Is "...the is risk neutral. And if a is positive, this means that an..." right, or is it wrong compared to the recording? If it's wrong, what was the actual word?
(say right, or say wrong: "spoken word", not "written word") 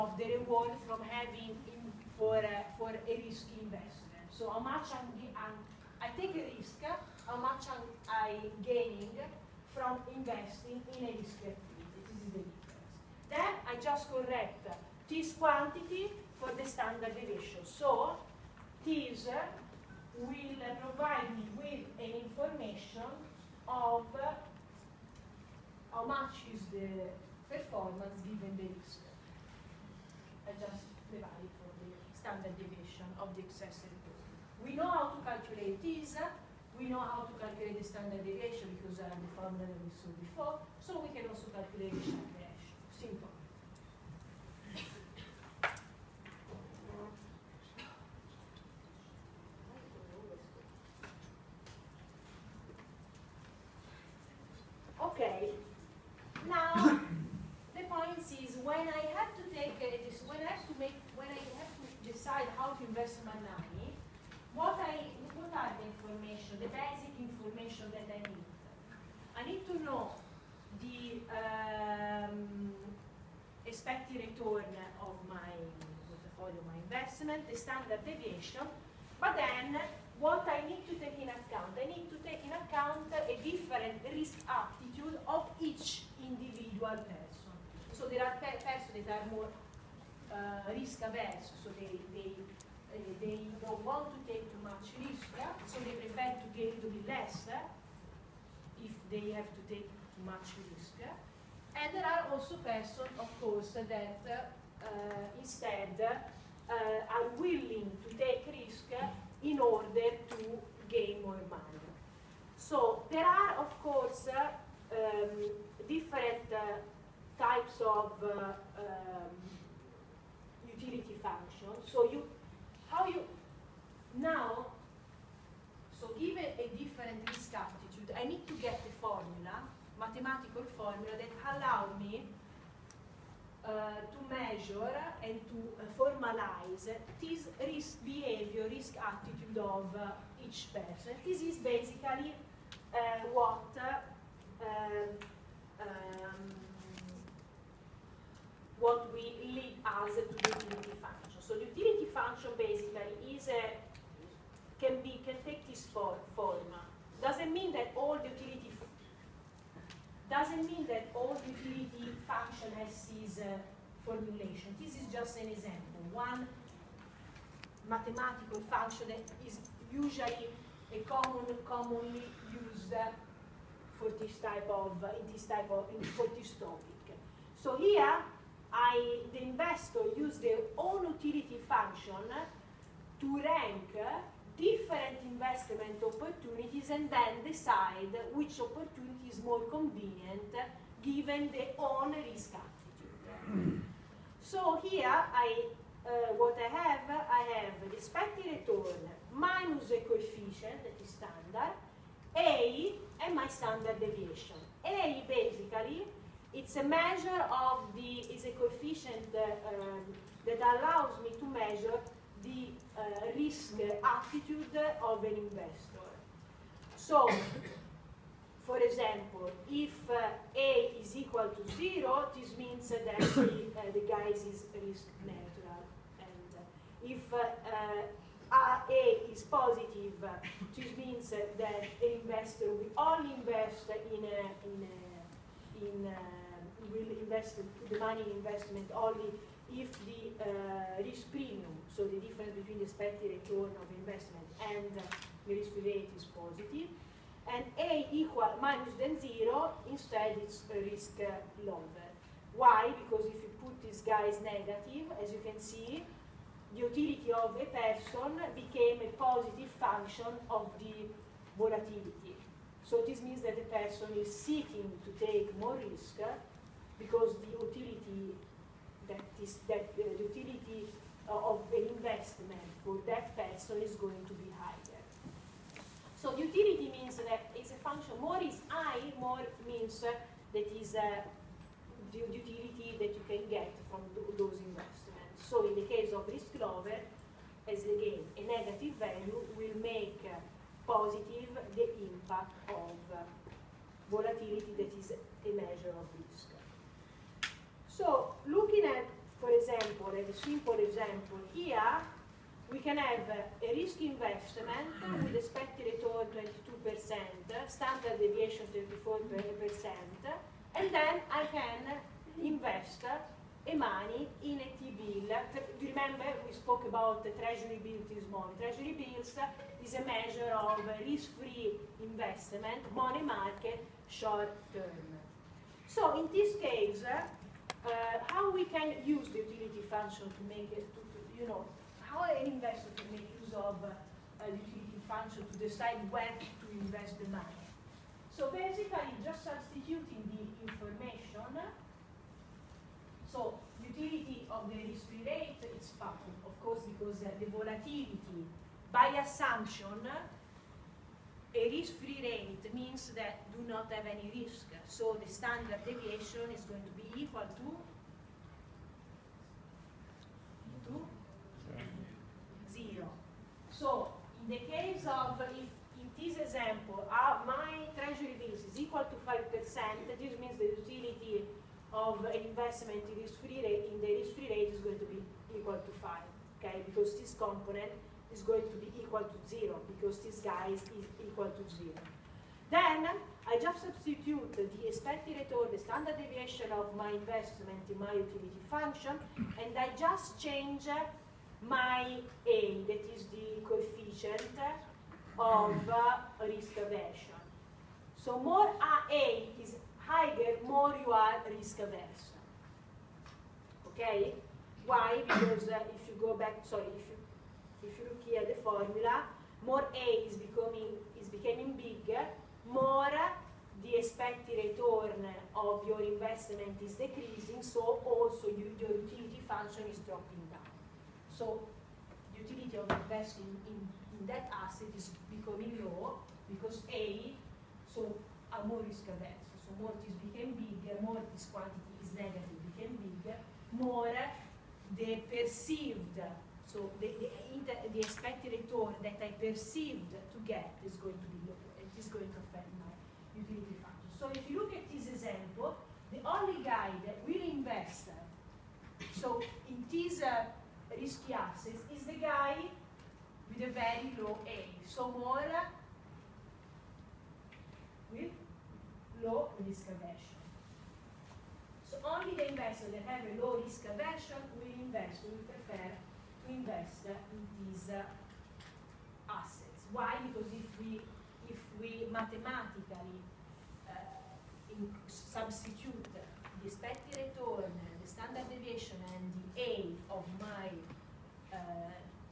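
right.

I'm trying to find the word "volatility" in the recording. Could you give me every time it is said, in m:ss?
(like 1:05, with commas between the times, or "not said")
4:21, 4:54, 5:47.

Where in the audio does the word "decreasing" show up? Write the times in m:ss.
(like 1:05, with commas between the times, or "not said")
6:56.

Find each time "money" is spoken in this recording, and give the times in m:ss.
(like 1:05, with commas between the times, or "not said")
1:51, 3:57, 5:13, 5:22, 5:37.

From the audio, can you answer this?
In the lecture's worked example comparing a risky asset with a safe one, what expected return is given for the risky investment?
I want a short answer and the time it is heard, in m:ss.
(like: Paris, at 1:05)
22%, at 5:06.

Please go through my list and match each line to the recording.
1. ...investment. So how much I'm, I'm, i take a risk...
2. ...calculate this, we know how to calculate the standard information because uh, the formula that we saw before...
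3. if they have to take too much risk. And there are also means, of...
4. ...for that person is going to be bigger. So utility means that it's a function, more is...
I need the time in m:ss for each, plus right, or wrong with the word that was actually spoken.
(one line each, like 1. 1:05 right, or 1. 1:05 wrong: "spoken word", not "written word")
1. 0:03 right
2. 0:35 wrong: "deviation", not "information"
3. 1:38 wrong: "persons", not "means"
4. 4:32 wrong: "higher", not "bigger".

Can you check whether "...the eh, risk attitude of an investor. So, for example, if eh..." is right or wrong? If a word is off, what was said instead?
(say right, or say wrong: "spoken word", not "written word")
right.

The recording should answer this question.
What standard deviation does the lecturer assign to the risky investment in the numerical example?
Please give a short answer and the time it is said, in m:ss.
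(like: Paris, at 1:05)
34%, at 5:08.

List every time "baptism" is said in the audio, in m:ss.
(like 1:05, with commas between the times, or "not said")
not said.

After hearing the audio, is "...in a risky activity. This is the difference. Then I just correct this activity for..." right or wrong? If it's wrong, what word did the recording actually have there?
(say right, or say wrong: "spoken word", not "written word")
wrong: "quantity", not "activity".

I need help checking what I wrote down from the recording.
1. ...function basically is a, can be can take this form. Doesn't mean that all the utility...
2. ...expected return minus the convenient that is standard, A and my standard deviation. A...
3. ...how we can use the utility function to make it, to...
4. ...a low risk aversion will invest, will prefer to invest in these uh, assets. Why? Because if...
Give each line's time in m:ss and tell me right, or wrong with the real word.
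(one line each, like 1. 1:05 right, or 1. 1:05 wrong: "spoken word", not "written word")
1. 2:32 right
2. 3:17 wrong: "coefficient", not "convenient"
3. 5:28 right
4. 7:43 right.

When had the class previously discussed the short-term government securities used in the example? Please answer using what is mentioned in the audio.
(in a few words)
this morning.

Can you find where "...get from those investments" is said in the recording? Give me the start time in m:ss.
4:43.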